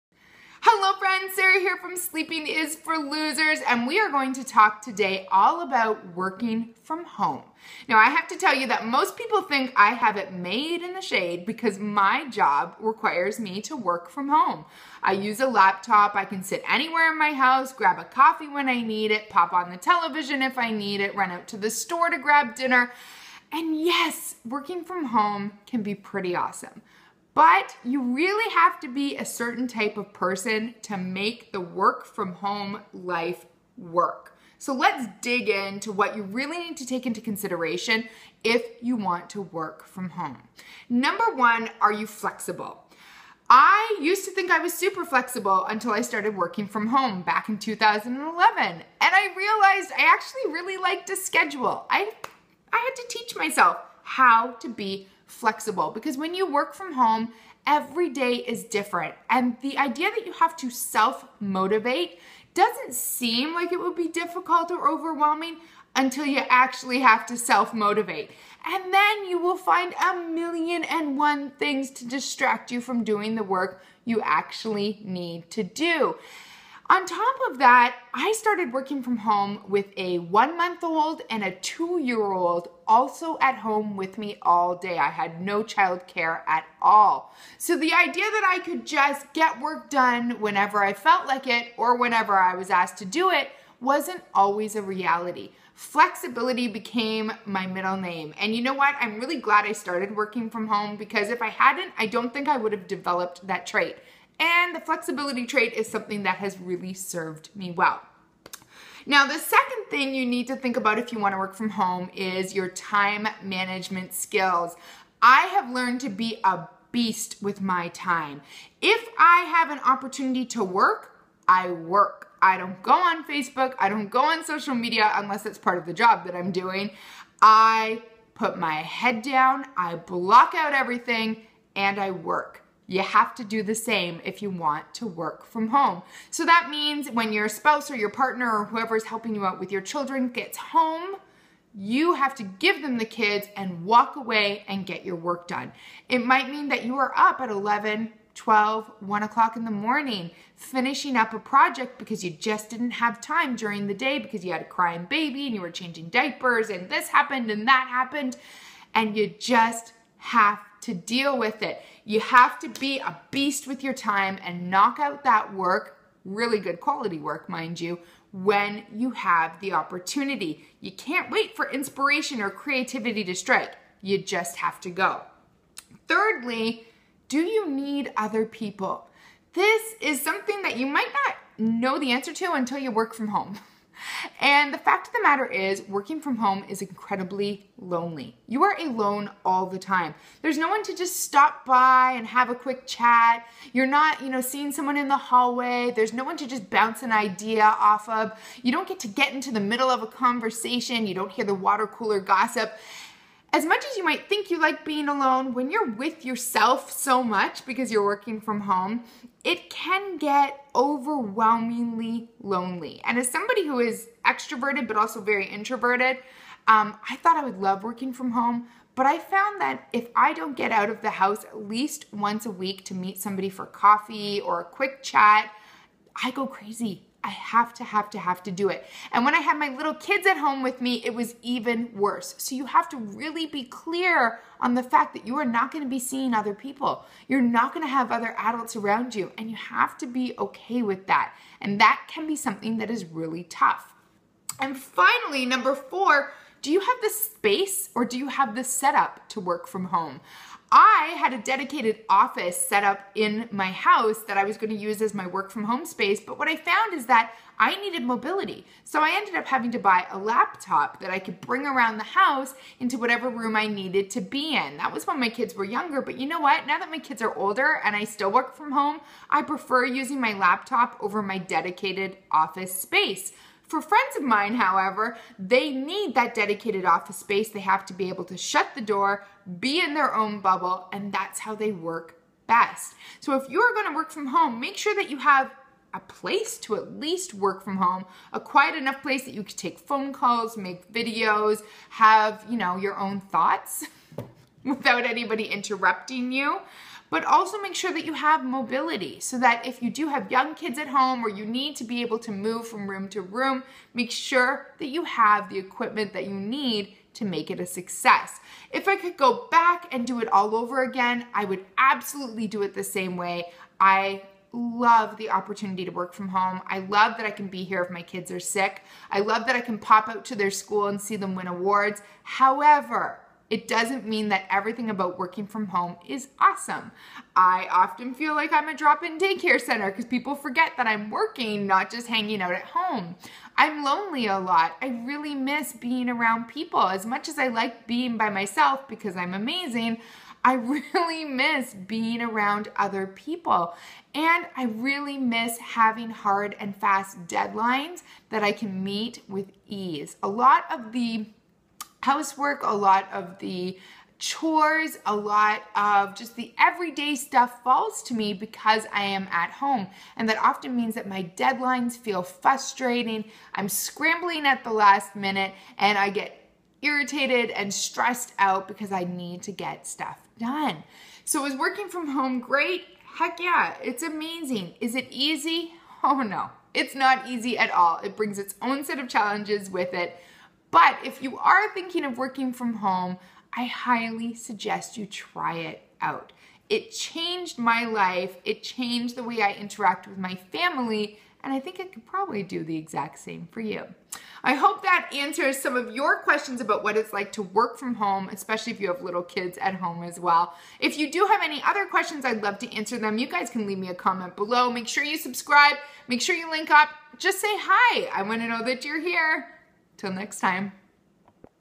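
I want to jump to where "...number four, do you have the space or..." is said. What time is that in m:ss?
4:05.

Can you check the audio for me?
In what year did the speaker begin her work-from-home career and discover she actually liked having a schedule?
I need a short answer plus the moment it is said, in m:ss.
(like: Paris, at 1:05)
2011, at 0:47.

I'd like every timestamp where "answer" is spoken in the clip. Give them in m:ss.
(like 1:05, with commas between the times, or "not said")
3:02, 6:35, 6:42.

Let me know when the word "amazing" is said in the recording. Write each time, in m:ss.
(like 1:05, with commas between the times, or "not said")
5:39, 6:14.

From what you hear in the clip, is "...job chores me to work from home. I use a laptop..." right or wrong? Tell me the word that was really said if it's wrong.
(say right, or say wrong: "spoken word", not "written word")
wrong: "requires", not "chores".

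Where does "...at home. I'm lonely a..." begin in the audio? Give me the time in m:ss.
5:32.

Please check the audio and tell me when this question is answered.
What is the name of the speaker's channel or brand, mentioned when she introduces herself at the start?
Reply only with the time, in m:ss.
0:01.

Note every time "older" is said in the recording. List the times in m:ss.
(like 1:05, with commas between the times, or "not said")
4:27.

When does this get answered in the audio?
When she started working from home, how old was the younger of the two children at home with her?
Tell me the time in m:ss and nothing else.
1:20.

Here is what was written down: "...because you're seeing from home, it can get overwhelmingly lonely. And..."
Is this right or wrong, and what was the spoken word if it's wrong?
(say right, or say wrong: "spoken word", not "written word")
wrong: "working", not "seeing".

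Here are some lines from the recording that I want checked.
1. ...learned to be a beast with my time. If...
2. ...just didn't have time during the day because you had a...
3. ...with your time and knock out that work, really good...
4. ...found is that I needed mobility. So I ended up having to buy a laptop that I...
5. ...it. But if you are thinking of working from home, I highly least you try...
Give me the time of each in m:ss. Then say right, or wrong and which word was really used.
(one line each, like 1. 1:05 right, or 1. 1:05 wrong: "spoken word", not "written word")
1. 1:55 right
2. 2:32 right
3. 2:43 right
4. 4:16 right
5. 6:19 wrong: "suggest", not "least".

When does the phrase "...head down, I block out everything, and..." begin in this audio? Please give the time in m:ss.
2:08.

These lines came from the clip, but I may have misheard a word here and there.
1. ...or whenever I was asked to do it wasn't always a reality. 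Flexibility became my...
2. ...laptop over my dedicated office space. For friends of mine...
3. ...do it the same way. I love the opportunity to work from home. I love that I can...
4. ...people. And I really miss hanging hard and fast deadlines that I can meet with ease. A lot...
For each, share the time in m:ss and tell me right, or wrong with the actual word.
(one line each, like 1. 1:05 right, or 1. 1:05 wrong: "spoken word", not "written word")
1. 1:31 right
2. 4:30 right
3. 5:12 right
4. 5:43 wrong: "having", not "hanging".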